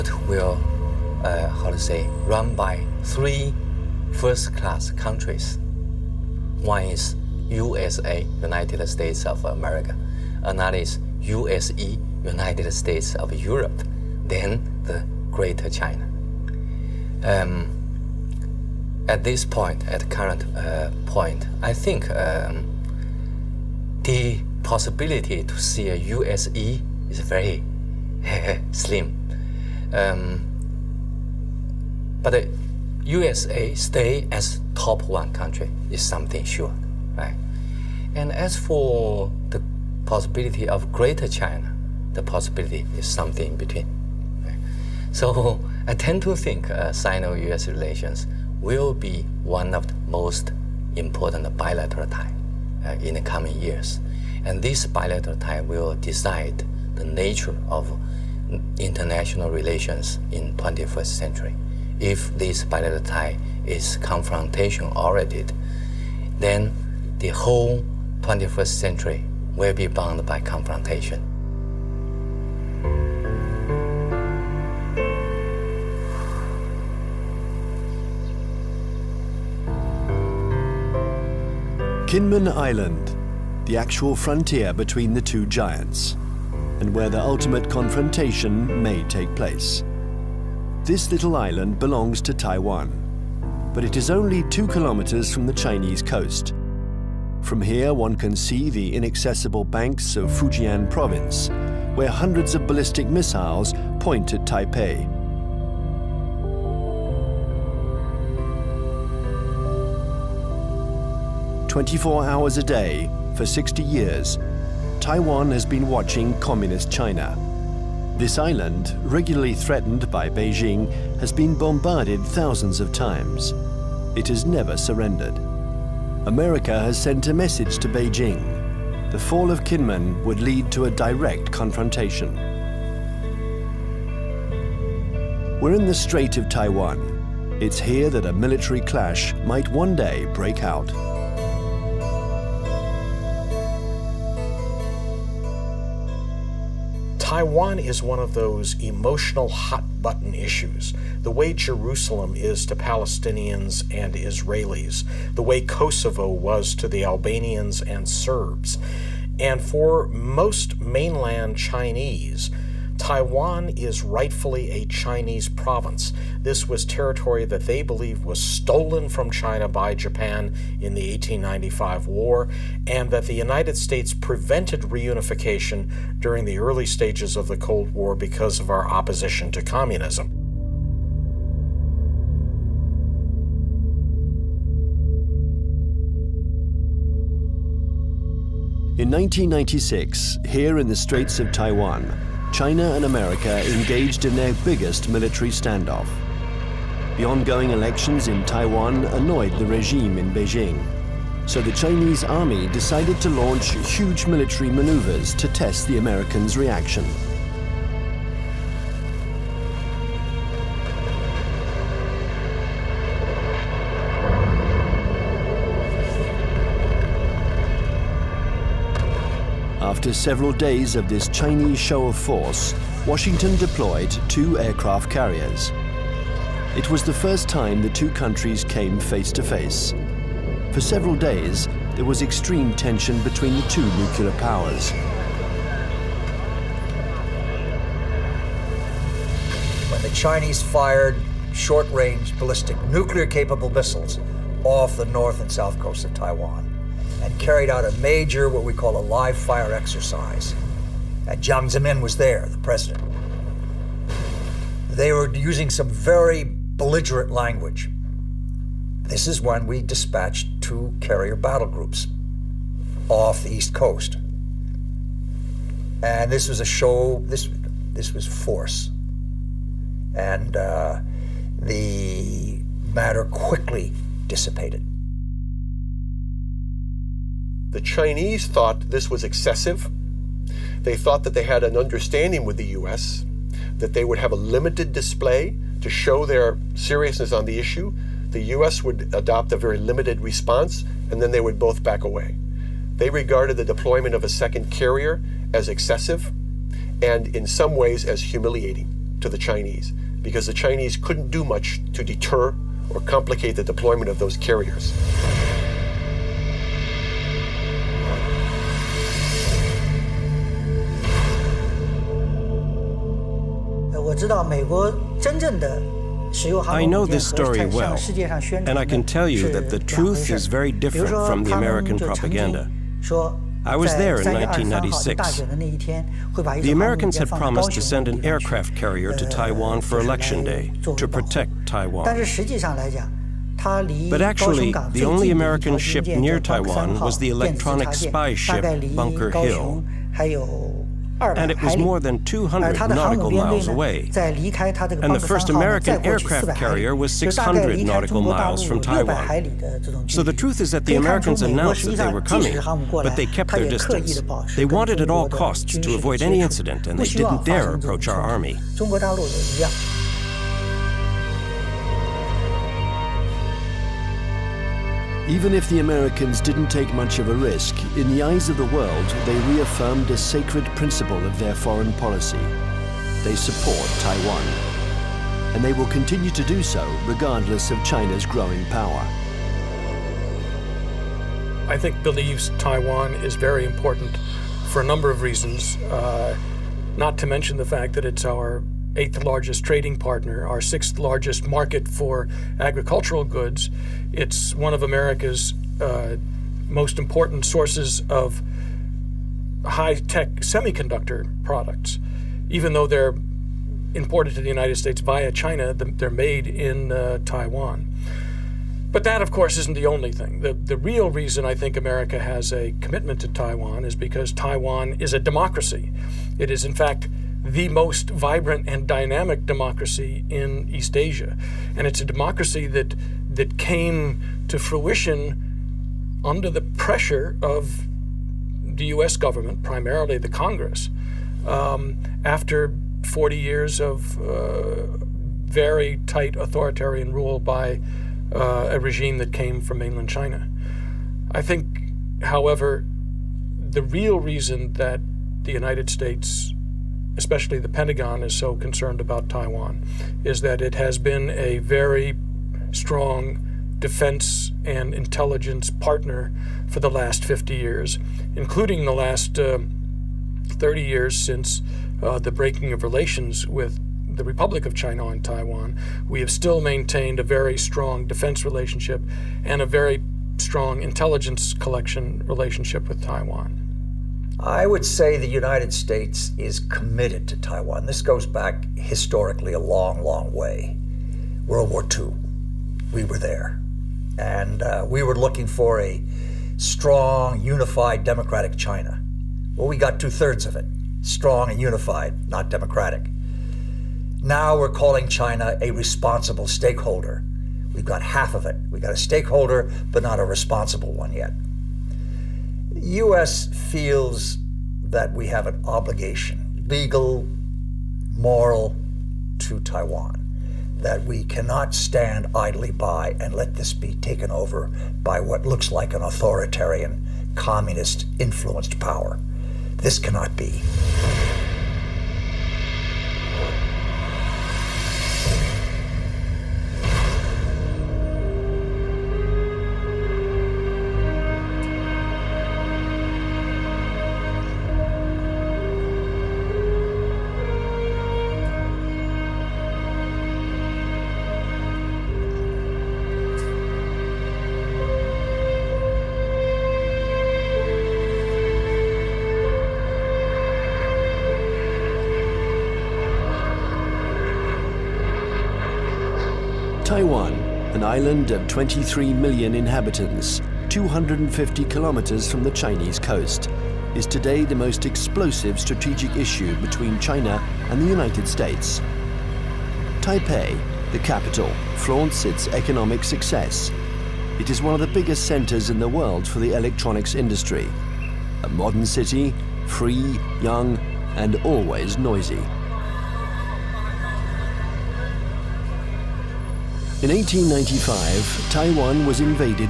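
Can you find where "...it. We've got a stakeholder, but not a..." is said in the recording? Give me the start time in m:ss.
8:18.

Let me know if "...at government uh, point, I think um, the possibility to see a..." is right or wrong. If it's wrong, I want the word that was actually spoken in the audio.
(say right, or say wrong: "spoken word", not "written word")
wrong: "current", not "government".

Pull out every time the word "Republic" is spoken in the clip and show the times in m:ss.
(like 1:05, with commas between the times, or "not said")
7:44.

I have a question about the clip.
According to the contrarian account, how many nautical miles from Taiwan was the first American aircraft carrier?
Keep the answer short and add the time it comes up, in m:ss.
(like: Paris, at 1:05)
600, at 5:47.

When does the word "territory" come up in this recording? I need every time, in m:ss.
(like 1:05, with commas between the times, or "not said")
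2:46.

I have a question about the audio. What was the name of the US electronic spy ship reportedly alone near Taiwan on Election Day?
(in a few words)
Bunker Hill.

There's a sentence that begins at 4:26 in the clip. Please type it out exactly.
And this was a show, this, this was force.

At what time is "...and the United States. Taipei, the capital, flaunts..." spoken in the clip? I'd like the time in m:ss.
9:27.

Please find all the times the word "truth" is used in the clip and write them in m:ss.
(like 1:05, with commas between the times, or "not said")
5:19, 5:50.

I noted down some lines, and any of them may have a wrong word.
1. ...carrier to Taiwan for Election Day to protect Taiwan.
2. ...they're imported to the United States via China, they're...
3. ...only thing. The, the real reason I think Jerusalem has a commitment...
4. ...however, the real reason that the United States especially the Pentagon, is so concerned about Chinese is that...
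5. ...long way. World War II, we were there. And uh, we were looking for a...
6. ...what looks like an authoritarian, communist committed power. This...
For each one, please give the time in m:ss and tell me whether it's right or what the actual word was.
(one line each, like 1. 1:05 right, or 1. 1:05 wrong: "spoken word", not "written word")
1. 5:28 right
2. 6:42 right
3. 6:49 wrong: "America", not "Jerusalem"
4. 7:22 wrong: "Taiwan", not "Chinese"
5. 8:00 right
6. 8:35 wrong: "influenced", not "committed".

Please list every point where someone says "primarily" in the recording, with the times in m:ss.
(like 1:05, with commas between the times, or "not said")
7:09.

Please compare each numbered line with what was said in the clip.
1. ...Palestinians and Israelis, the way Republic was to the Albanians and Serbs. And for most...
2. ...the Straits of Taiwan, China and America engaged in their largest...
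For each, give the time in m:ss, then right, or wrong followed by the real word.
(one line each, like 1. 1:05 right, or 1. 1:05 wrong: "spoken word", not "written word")
1. 2:32 wrong: "Kosovo", not "Republic"
2. 3:10 wrong: "biggest", not "largest".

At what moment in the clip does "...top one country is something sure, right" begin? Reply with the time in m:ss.
0:34.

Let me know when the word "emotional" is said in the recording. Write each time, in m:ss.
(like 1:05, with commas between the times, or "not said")
2:28.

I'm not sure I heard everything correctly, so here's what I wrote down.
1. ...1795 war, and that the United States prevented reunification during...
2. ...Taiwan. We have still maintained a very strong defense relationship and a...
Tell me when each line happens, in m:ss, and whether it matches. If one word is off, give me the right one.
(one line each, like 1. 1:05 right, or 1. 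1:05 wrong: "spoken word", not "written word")
1. 2:51 wrong: "1895", not "1795"
2. 7:45 right.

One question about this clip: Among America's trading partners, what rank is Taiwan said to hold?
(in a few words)
eighth.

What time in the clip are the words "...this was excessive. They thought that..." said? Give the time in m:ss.
4:38.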